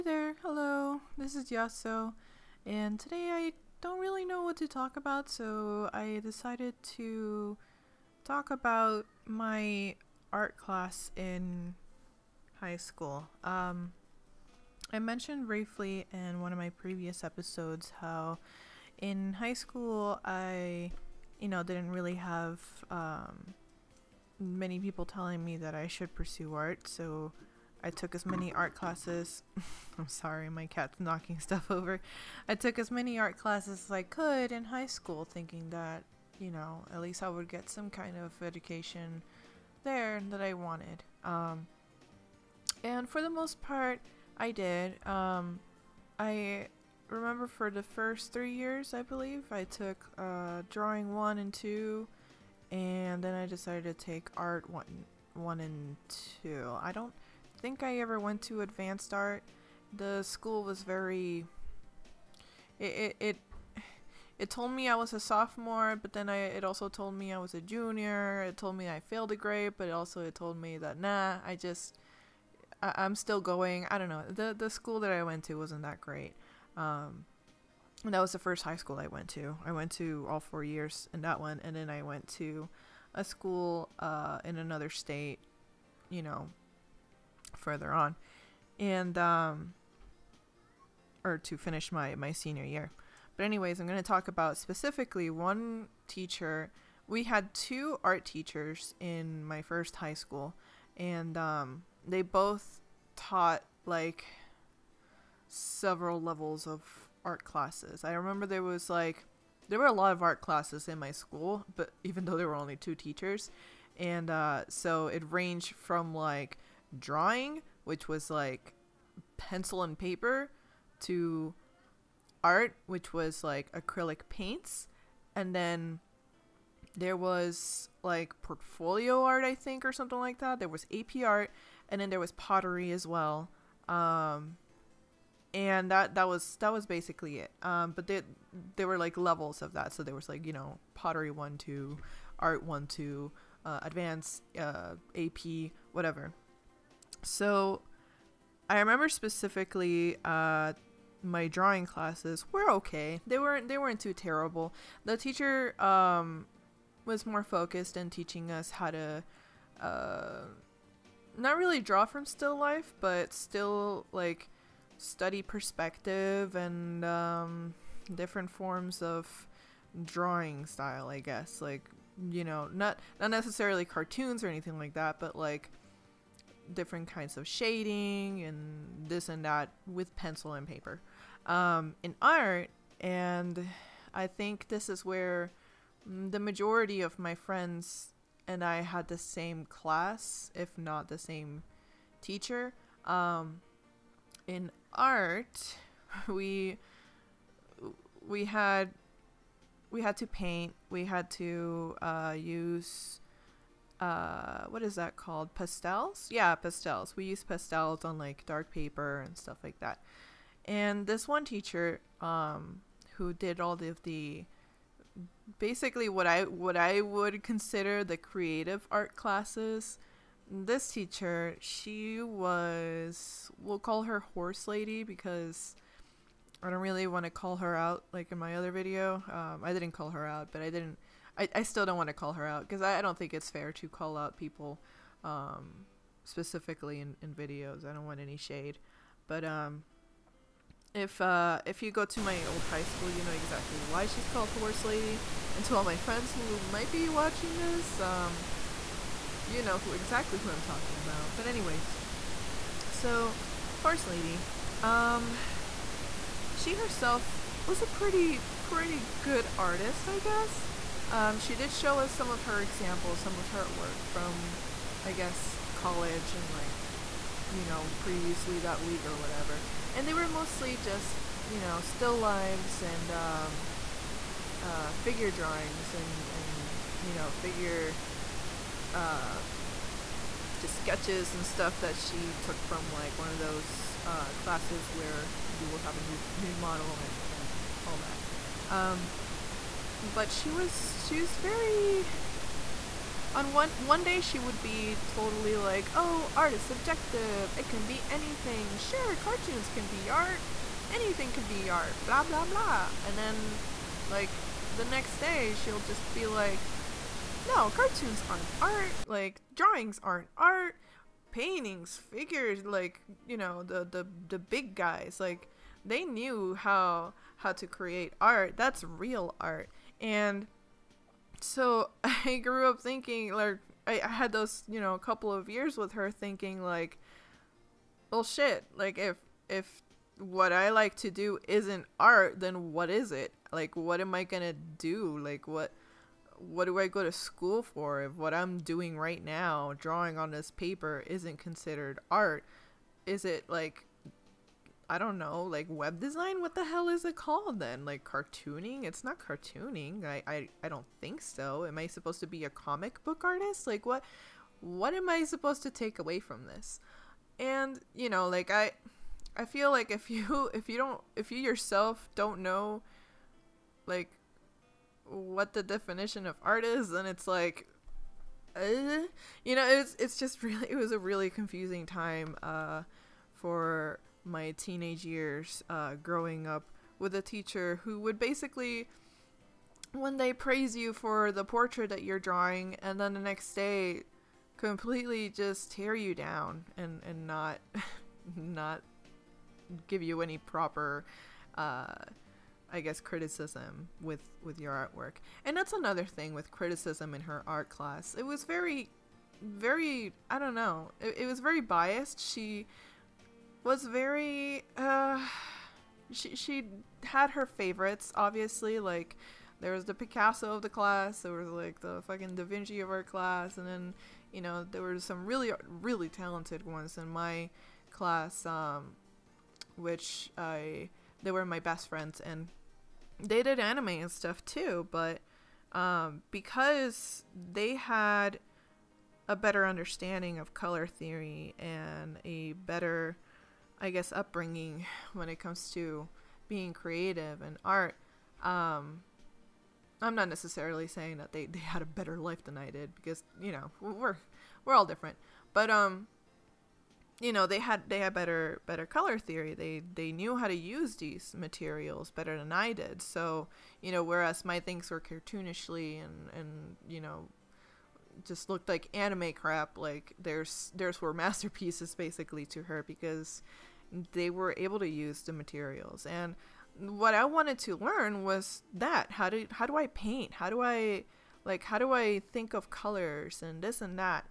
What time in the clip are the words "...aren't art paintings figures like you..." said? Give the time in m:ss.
5:10.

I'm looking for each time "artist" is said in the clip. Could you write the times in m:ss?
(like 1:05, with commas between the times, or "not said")
4:19, 5:53.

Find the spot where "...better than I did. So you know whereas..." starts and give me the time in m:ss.
7:32.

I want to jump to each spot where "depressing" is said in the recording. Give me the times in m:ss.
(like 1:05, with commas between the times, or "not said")
not said.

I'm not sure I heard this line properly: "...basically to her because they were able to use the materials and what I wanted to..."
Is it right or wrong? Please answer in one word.
right.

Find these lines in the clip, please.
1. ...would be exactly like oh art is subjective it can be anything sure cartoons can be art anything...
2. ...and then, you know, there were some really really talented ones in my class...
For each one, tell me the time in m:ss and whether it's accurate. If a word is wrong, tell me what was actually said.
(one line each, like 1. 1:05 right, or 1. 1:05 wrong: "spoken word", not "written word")
1. 4:54 wrong: "totally", not "exactly"
2. 6:53 right.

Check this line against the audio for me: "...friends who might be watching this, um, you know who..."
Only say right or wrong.
right.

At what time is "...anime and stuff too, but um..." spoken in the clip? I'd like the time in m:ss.
7:03.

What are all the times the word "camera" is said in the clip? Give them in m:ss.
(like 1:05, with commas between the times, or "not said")
not said.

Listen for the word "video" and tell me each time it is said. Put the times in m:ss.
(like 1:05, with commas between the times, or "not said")
3:48, 3:57.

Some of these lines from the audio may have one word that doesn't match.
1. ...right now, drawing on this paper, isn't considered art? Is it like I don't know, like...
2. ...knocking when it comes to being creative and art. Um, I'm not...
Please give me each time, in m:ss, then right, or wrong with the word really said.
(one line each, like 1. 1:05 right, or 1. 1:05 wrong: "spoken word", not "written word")
1. 5:38 right
2. 7:14 wrong: "upbringing", not "knocking".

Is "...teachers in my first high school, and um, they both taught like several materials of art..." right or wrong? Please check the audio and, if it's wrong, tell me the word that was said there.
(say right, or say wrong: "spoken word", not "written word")
wrong: "levels", not "materials".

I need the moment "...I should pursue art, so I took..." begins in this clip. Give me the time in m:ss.
0:25.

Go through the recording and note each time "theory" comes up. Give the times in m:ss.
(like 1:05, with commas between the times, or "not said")
7:10, 7:29.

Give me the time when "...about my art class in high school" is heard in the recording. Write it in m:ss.
0:08.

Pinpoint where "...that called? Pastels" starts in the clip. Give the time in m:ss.
3:24.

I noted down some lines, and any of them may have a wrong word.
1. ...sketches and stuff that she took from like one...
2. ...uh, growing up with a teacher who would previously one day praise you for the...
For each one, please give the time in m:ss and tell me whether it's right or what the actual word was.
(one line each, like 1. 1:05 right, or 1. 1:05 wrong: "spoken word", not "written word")
1. 4:40 right
2. 6:15 wrong: "basically", not "previously".